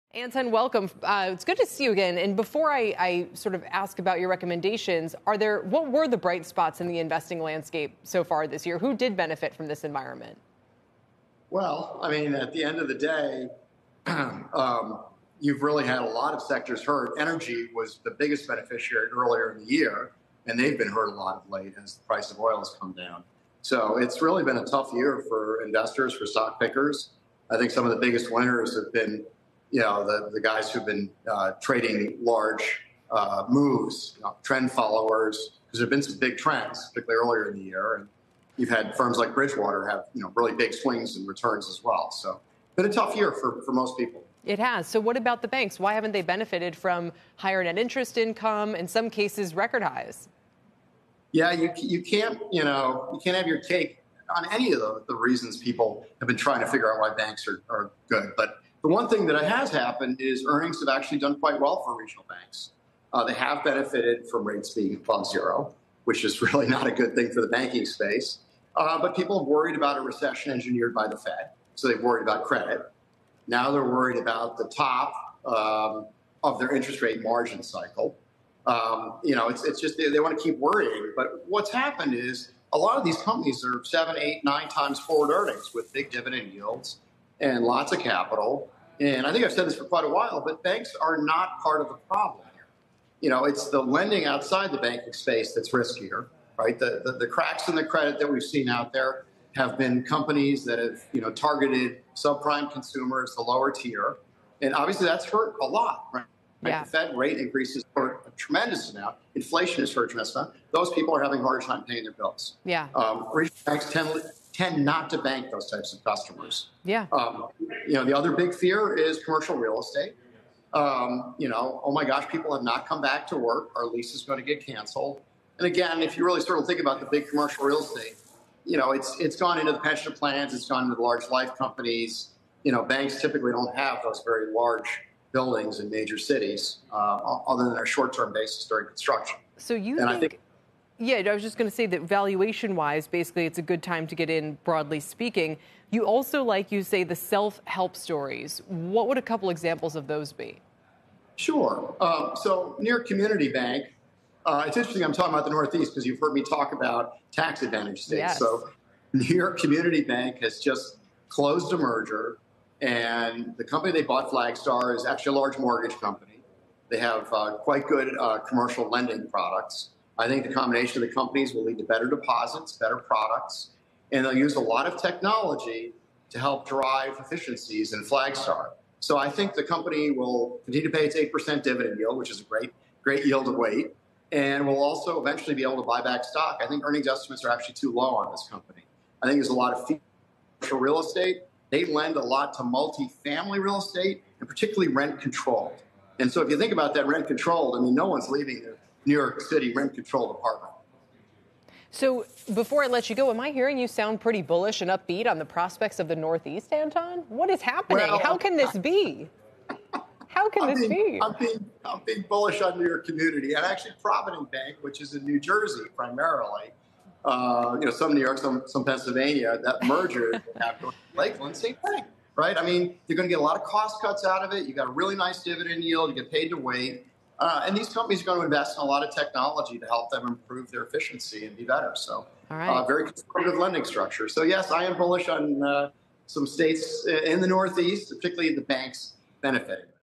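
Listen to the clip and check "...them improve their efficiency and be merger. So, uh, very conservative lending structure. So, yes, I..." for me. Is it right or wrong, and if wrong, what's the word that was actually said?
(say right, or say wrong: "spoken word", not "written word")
wrong: "better", not "merger".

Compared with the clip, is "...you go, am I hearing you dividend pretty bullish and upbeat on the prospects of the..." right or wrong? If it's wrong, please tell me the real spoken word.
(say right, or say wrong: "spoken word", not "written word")
wrong: "sound", not "dividend".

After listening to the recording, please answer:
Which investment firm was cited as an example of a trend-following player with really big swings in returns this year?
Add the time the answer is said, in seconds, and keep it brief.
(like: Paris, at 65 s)
Bridgewater, at 39 s.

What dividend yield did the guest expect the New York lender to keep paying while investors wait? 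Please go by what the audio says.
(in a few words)
8%.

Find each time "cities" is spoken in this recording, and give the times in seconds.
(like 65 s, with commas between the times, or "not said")
136 s.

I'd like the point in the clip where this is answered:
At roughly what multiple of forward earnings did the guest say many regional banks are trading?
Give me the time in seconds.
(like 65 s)
83 s.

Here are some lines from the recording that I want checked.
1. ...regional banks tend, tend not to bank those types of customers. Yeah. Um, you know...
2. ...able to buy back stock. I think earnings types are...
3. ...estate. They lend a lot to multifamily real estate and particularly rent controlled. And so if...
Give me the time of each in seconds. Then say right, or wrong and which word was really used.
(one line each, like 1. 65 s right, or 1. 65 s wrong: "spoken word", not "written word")
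1. 113 s right
2. 185 s wrong: "estimates", not "types"
3. 190 s right.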